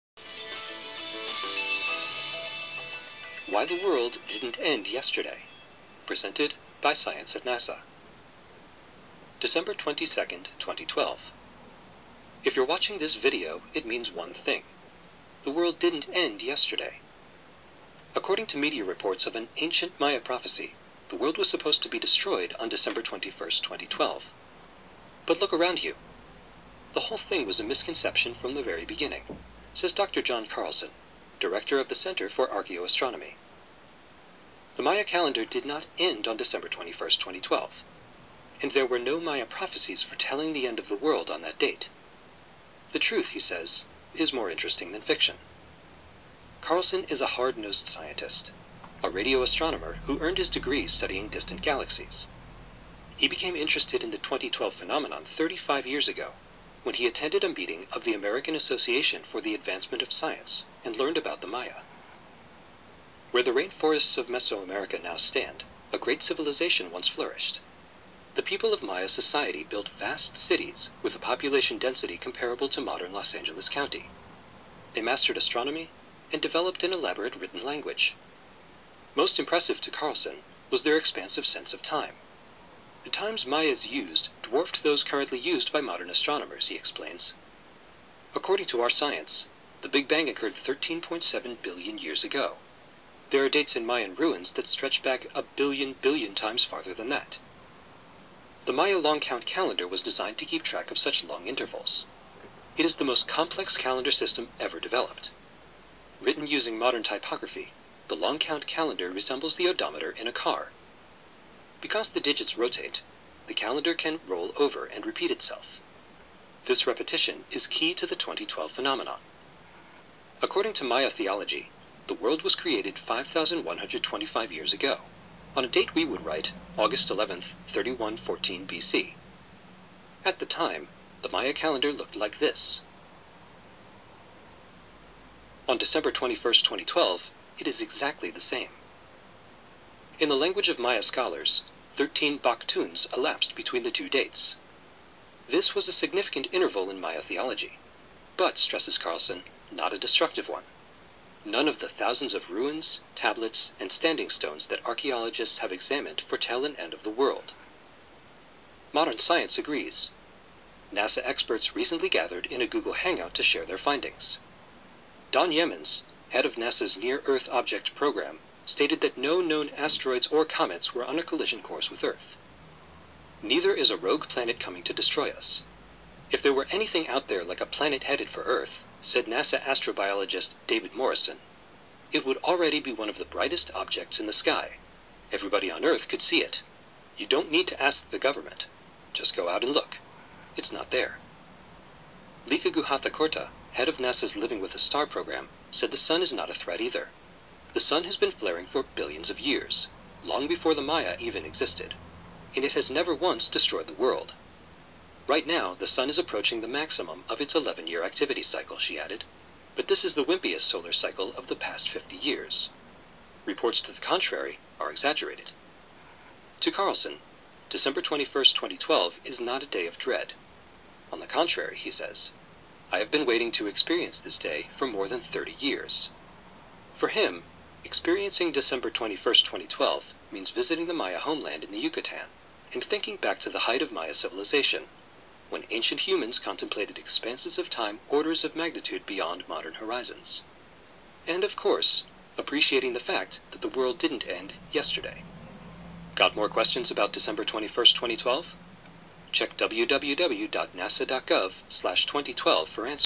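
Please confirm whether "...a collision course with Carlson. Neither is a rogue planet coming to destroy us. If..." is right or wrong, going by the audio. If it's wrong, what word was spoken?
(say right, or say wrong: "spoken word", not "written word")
wrong: "Earth", not "Carlson".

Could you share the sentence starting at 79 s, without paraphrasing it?
Most impressive to Carlson was their expansive sense of time.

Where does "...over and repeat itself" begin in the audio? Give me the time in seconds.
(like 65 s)
114 s.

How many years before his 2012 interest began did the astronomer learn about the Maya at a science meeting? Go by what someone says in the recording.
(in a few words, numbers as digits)
35 years.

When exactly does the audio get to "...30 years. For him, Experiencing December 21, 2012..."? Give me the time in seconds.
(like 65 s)
225 s.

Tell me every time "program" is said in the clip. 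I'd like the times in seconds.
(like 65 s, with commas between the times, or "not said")
167 s, 195 s.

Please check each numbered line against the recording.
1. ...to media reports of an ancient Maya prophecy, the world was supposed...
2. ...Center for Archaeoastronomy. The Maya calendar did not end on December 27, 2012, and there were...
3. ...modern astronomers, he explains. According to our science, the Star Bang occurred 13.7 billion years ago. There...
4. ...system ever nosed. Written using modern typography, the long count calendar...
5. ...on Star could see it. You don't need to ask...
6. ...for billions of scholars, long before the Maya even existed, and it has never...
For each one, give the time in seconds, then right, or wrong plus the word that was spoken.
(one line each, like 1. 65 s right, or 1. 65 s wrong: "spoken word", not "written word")
1. 18 s right
2. 31 s wrong: "21", not "27"
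3. 85 s wrong: "Big", not "Star"
4. 104 s wrong: "developed", not "nosed"
5. 185 s wrong: "Earth", not "Star"
6. 198 s wrong: "years", not "scholars".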